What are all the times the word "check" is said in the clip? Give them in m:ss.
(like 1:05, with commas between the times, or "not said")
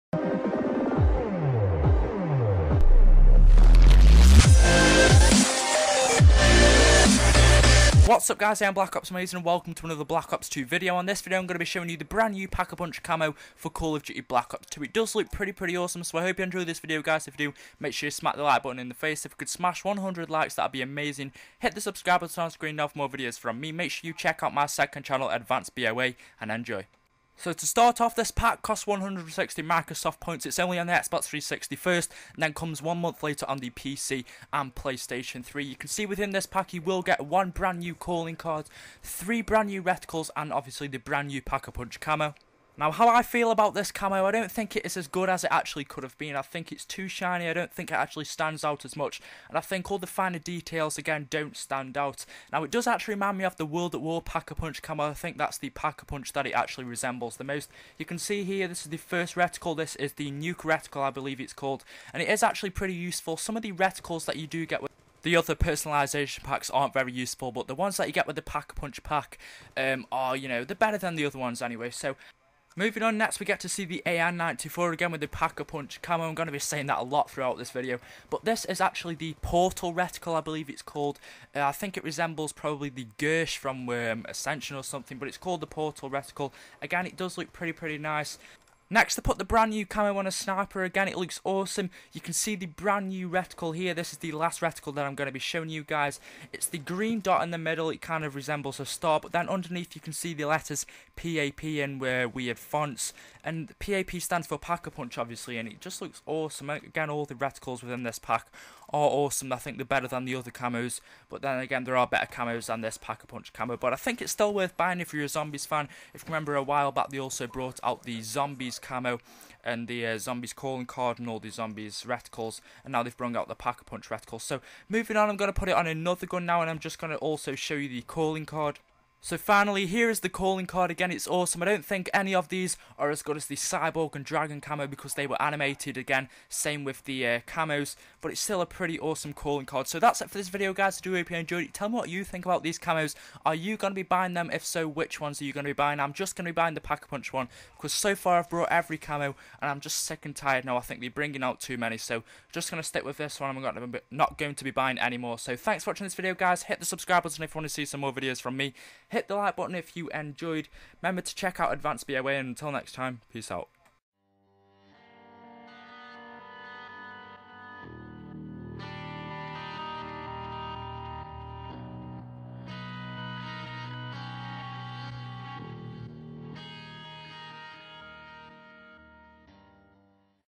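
0:24, 2:41.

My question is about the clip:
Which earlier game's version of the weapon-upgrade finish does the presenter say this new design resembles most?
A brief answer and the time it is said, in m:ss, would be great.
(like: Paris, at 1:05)
World at War, at 0:53.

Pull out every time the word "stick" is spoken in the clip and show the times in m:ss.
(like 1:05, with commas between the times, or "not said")
2:32.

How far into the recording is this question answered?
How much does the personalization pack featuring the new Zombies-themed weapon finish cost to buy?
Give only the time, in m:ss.
0:28.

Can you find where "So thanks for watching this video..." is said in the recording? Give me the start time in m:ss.
2:35.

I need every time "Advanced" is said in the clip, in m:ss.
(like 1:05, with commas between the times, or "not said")
0:25, 2:41.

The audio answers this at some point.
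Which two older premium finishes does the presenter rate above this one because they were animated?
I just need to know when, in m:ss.
2:13.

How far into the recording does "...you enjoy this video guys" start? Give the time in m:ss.
0:16.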